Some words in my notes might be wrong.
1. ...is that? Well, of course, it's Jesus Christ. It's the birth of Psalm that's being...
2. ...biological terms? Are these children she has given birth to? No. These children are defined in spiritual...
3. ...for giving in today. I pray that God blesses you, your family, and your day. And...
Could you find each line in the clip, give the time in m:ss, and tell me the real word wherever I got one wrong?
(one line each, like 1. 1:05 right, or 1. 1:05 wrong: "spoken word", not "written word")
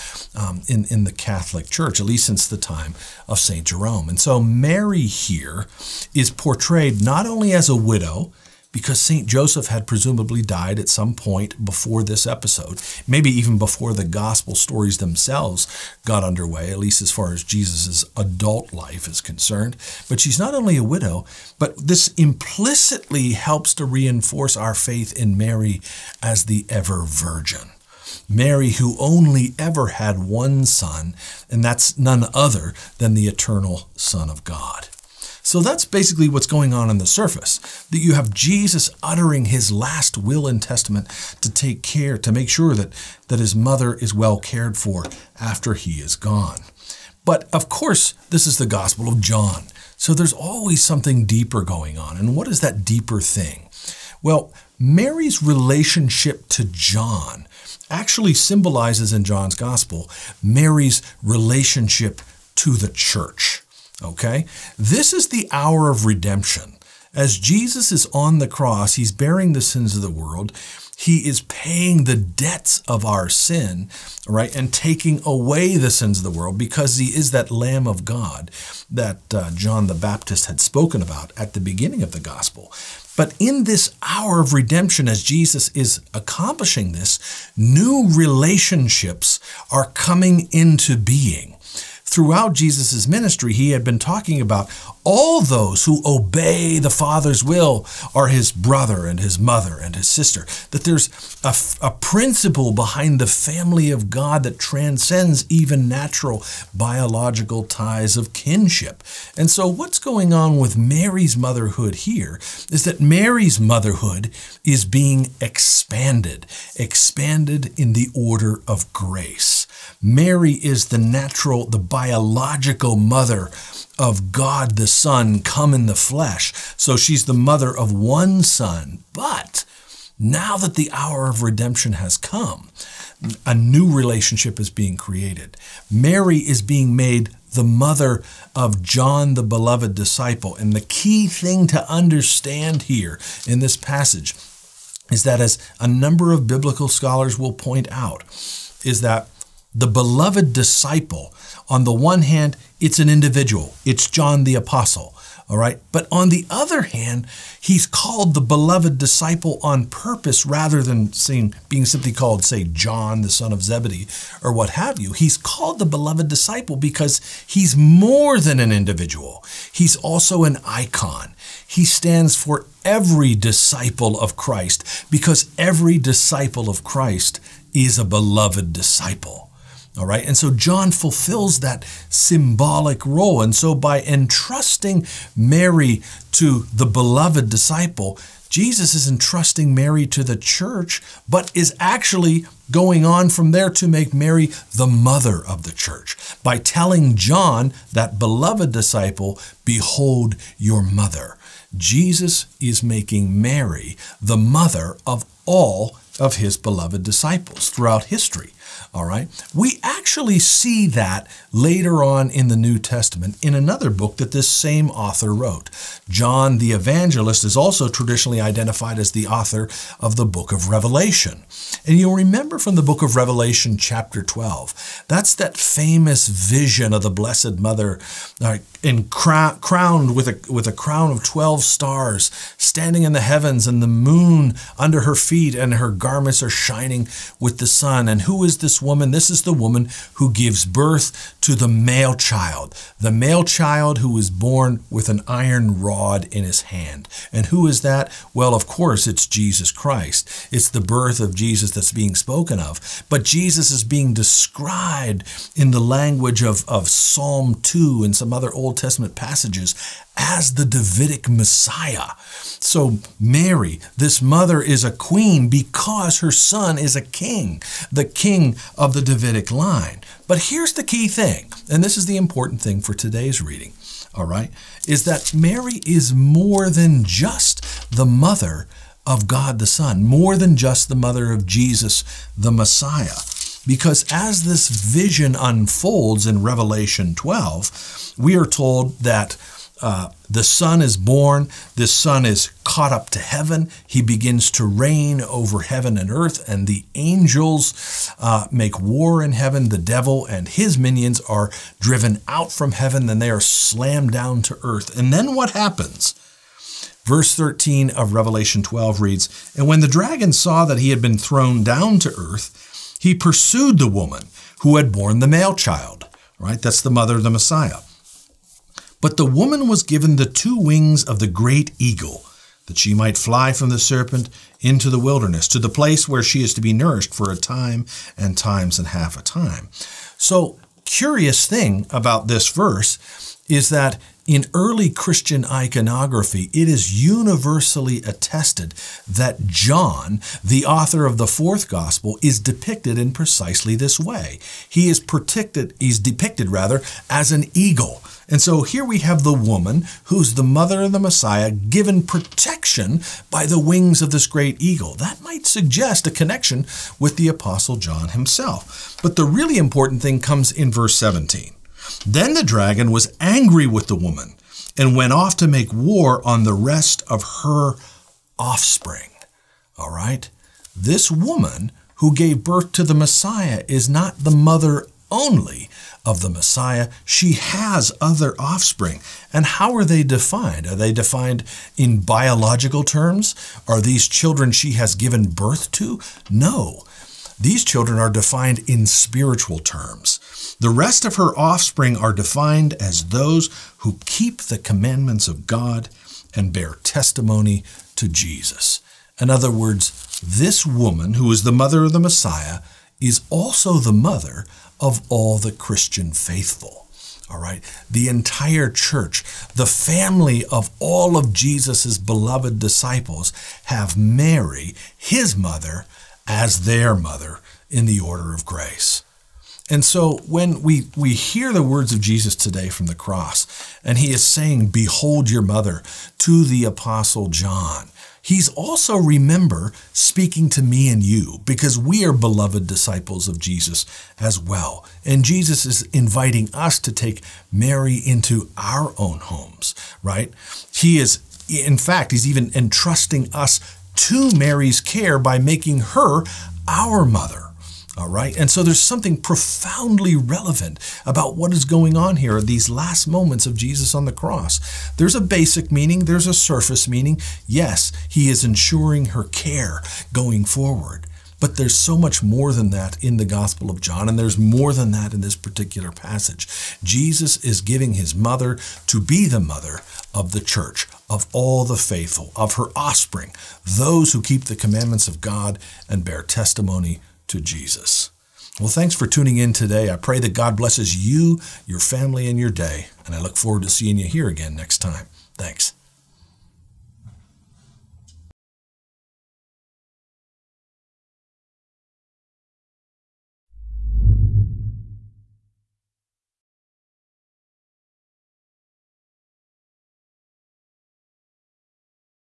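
1. 4:07 wrong: "Jesus", not "Psalm"
2. 6:22 right
3. 7:58 wrong: "tuning", not "giving".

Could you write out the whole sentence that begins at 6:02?
Then the dragon was angry with the woman and went off to make war on the rest of her offspring.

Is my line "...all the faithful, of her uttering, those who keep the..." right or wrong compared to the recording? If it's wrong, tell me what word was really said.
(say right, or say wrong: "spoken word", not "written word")
wrong: "offspring", not "uttering".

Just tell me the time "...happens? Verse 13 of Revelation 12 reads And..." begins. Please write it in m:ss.
5:05.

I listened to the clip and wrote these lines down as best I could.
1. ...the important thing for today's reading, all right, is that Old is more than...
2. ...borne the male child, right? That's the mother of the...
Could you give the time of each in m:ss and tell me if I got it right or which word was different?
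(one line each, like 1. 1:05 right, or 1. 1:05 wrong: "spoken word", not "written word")
1. 4:32 wrong: "Mary", not "Old"
2. 5:14 right.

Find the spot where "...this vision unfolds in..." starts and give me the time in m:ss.
4:44.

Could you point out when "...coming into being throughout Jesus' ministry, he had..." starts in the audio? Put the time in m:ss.
1:29.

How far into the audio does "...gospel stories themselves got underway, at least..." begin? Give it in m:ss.
0:14.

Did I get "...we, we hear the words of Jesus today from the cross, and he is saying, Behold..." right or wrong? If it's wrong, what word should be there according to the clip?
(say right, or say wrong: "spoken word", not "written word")
right.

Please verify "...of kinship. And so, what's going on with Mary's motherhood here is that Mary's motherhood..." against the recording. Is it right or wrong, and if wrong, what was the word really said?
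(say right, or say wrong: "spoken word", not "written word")
right.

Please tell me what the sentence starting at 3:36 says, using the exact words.
John the Evangelist is also traditionally identified as the author of the book of Revelation.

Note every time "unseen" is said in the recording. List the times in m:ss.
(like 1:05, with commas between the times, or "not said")
not said.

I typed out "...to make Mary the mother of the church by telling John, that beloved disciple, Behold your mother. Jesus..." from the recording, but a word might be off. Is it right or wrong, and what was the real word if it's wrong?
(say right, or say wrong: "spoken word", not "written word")
right.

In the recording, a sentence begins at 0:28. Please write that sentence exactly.
Mary, who only ever had one son, and that's none other than the eternal Son of God.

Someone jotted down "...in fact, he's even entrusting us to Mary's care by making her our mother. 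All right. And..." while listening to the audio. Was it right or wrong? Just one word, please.
right.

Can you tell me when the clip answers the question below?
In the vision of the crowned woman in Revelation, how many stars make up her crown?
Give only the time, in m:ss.
3:51.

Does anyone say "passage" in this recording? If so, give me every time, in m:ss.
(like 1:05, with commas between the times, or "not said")
2:23, 4:19, 7:45.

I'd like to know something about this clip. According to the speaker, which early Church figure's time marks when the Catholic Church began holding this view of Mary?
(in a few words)
St. Jerome.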